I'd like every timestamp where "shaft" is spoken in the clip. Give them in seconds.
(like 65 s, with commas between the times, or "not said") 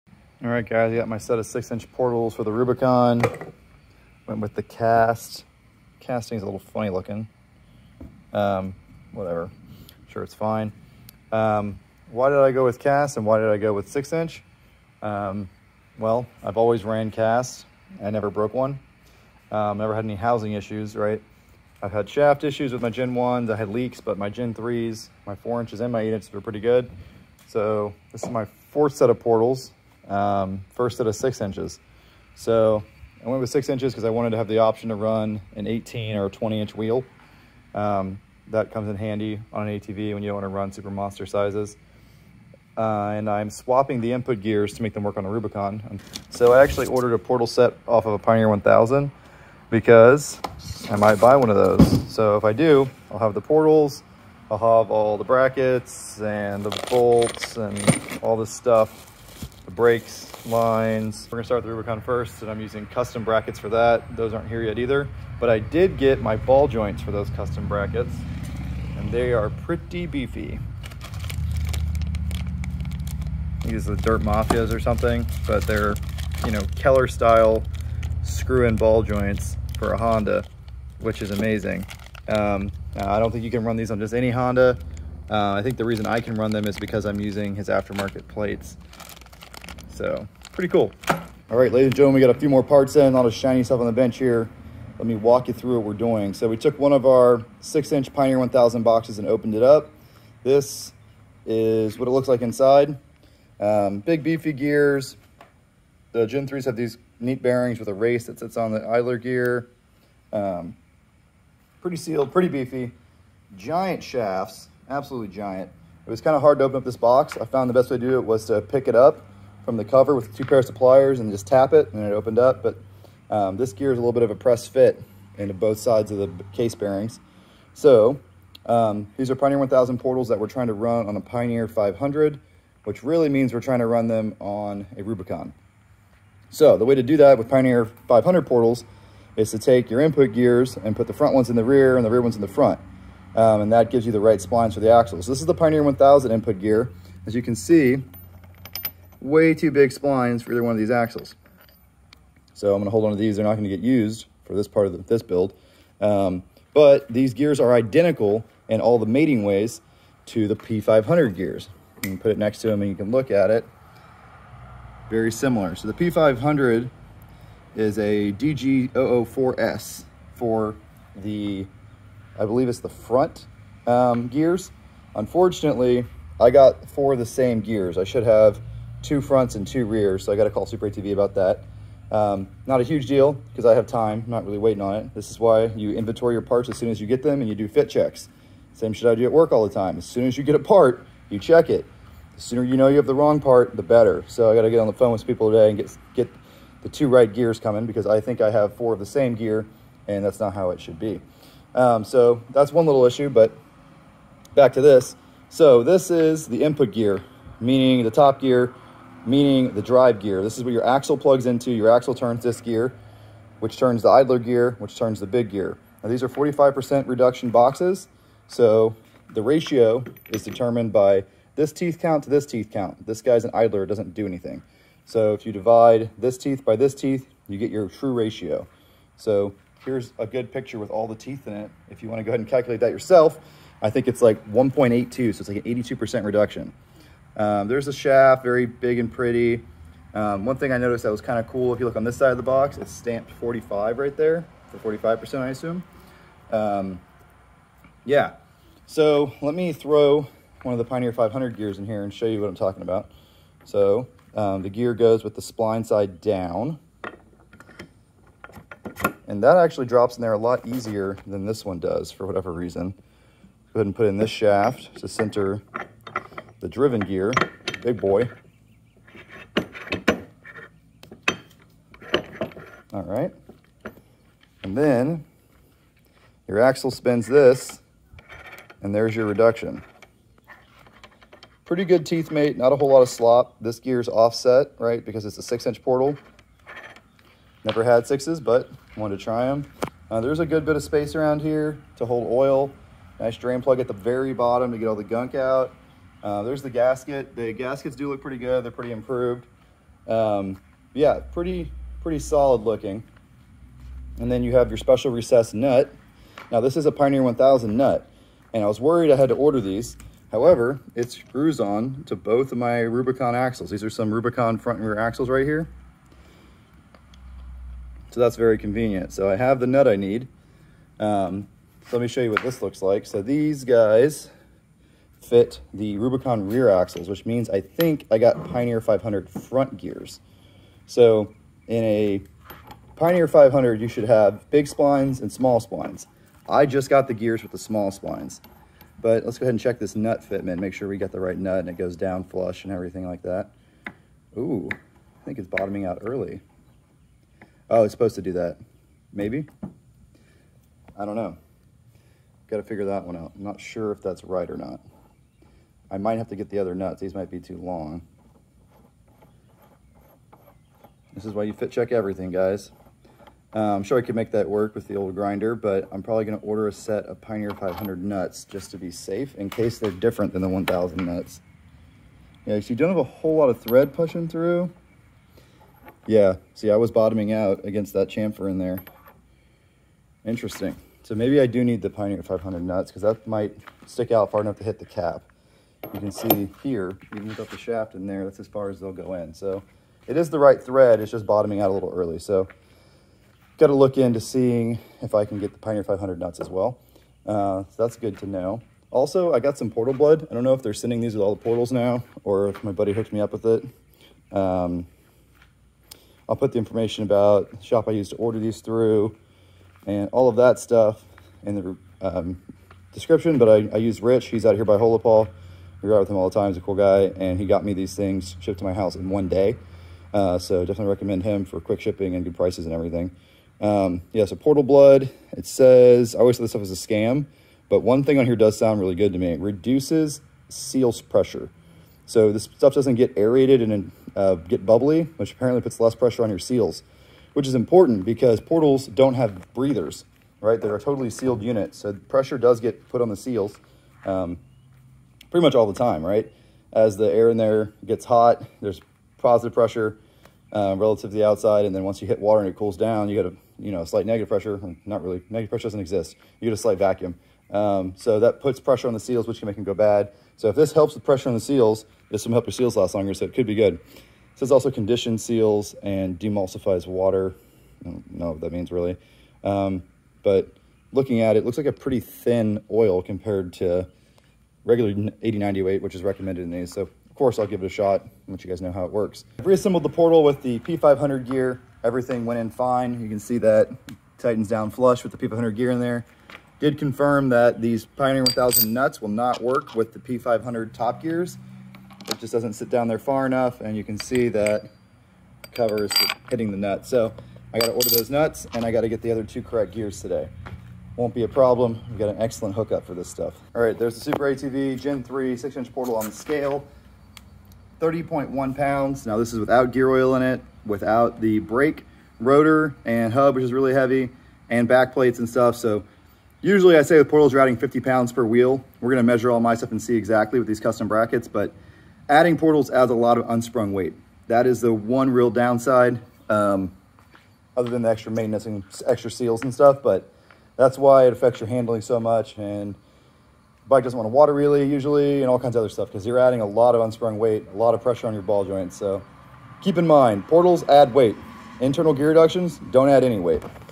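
22 s, 114 s, 237 s, 264 s, 387 s.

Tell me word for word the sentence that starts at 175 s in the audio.
Unfortunately, I got four of the same gears.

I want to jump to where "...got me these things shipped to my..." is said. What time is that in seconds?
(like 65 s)
417 s.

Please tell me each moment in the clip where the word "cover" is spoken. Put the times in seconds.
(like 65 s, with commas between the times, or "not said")
119 s, 495 s.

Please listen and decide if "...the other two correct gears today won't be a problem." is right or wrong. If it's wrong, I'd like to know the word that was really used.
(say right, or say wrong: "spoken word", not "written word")
right.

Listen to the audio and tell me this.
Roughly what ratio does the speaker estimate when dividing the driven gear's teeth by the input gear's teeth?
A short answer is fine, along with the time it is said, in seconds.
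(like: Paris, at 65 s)
1.82, at 234 s.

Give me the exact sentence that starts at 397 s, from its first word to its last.
Uh, so that's good to know.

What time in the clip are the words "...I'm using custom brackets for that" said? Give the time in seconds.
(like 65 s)
62 s.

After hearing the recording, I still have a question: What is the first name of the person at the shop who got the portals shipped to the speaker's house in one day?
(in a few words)
Rich.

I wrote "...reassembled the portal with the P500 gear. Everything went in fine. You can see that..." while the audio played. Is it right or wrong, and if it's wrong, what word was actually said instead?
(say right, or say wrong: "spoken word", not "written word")
right.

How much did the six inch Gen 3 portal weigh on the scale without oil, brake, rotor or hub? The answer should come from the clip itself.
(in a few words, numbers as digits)
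30.1 pounds.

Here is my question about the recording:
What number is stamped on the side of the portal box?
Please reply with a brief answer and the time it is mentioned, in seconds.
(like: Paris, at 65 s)
45, at 242 s.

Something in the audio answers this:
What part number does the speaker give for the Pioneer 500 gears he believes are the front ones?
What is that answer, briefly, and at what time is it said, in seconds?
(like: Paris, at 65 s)
DG004S, at 168 s.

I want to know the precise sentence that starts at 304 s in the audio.
And then you have your special recessed nut.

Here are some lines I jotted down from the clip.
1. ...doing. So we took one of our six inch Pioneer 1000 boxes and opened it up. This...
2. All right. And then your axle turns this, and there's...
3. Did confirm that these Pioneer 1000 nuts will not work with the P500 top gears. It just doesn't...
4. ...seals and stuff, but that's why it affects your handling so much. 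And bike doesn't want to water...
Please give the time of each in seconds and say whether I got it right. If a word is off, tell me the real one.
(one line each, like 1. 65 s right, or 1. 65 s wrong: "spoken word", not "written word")
1. 95 s right
2. 272 s wrong: "spins", not "turns"
3. 486 s right
4. 529 s right.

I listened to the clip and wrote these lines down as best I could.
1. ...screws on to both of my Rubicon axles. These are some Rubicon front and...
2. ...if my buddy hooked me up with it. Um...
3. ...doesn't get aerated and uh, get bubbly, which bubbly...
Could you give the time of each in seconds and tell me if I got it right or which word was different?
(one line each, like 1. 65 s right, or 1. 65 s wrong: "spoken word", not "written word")
1. 311 s right
2. 402 s right
3. 432 s wrong: "apparently", not "bubbly".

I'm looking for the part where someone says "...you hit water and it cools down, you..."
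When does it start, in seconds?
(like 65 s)
452 s.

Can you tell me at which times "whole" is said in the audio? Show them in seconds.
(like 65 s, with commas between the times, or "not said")
282 s, 373 s.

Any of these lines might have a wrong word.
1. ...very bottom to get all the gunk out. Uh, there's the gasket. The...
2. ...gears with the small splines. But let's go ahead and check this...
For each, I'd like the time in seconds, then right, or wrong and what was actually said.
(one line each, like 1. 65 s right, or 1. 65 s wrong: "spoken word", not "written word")
1. 293 s right
2. 337 s right.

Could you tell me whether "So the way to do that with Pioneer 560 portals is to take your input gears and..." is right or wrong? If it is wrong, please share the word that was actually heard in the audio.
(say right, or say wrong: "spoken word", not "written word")
wrong: "500", not "560".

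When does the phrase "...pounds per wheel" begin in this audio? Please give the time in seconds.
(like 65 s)
517 s.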